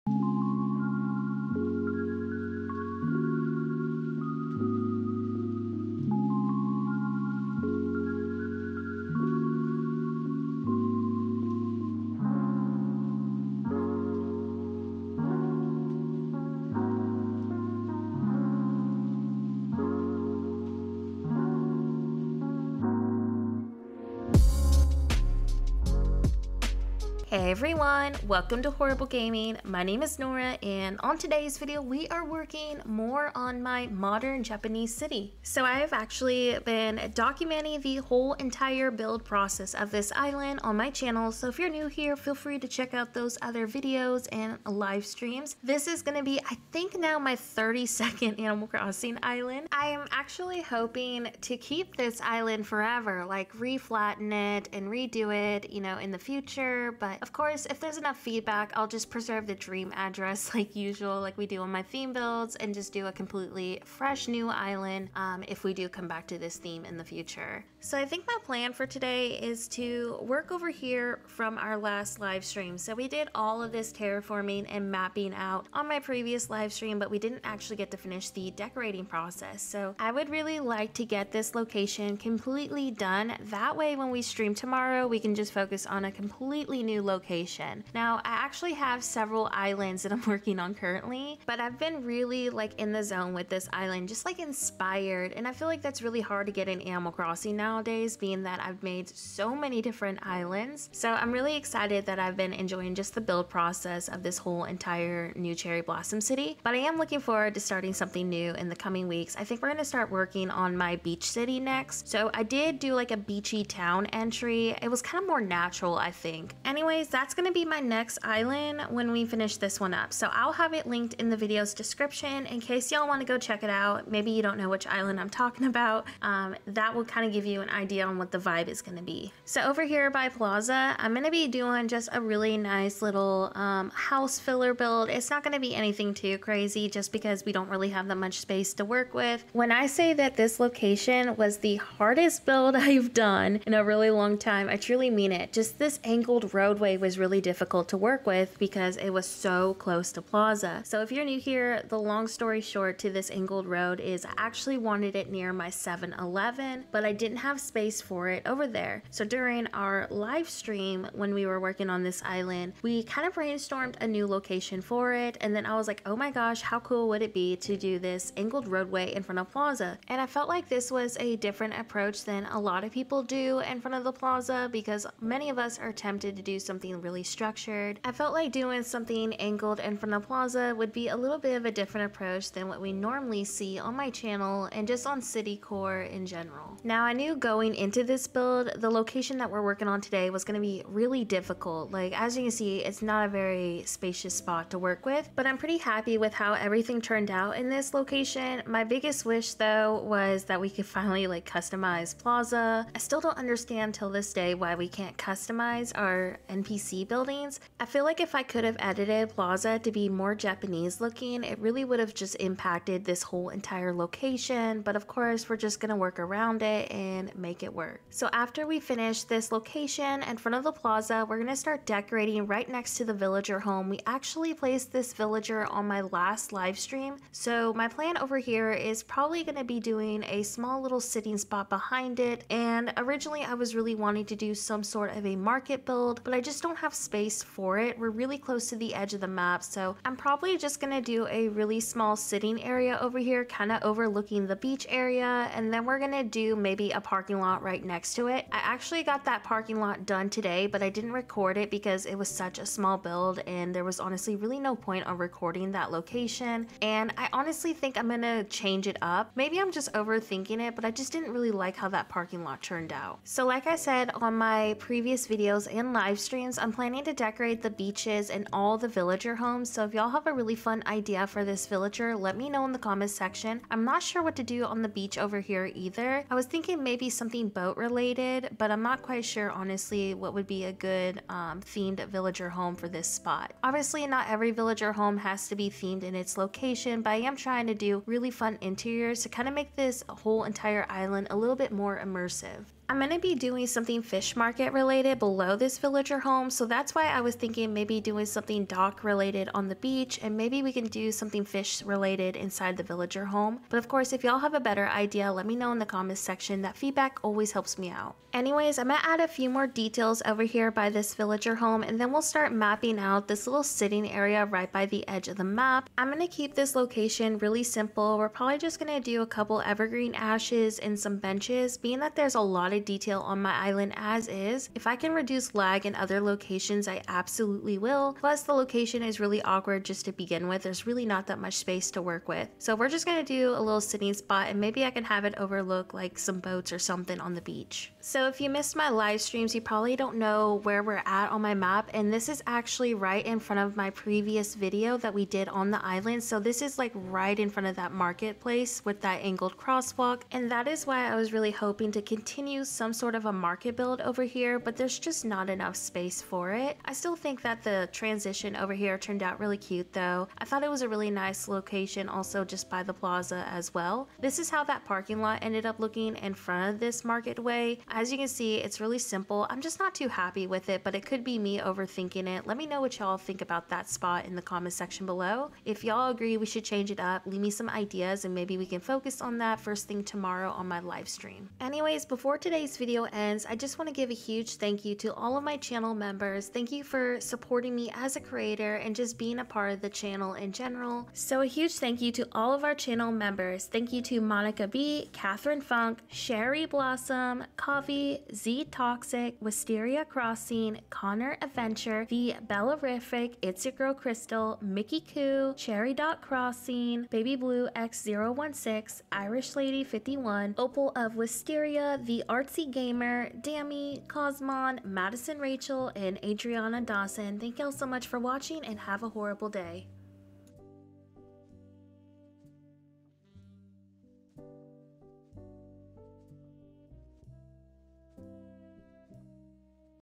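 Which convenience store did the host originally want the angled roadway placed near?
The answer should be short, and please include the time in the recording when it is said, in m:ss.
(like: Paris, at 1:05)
7-Eleven, at 2:35.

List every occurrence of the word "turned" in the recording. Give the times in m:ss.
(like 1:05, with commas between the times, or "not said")
3:16, 4:22, 5:58.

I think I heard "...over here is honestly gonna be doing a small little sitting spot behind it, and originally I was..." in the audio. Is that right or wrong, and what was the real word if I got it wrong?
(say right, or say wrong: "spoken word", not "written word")
wrong: "probably", not "honestly".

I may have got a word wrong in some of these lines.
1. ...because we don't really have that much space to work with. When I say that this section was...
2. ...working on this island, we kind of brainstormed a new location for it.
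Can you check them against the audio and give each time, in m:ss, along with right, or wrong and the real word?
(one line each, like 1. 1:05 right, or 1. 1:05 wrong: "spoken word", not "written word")
1. 2:17 wrong: "location", not "section"
2. 2:41 right.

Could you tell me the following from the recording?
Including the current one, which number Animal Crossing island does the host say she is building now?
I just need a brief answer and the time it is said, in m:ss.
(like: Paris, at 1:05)
32nd, at 0:47.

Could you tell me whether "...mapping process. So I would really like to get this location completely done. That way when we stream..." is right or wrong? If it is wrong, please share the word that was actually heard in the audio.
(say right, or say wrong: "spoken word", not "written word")
wrong: "decorating", not "mapping".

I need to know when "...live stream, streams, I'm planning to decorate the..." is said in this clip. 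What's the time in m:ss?
4:25.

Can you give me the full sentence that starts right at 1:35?
And I feel like that's really hard to get in Animal Crossing nowadays, being that I've made so many different islands.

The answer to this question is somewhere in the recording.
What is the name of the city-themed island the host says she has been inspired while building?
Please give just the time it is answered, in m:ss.
1:45.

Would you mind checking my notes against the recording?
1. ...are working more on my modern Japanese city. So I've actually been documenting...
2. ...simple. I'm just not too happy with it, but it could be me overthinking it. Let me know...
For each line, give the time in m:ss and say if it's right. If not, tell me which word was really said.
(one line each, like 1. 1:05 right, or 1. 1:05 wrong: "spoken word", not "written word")
1. 0:32 right
2. 6:08 right.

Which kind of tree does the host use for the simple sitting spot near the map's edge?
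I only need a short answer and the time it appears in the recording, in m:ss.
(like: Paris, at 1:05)
evergreen ashes, at 5:19.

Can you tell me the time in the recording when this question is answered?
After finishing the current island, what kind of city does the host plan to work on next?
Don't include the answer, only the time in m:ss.
1:50.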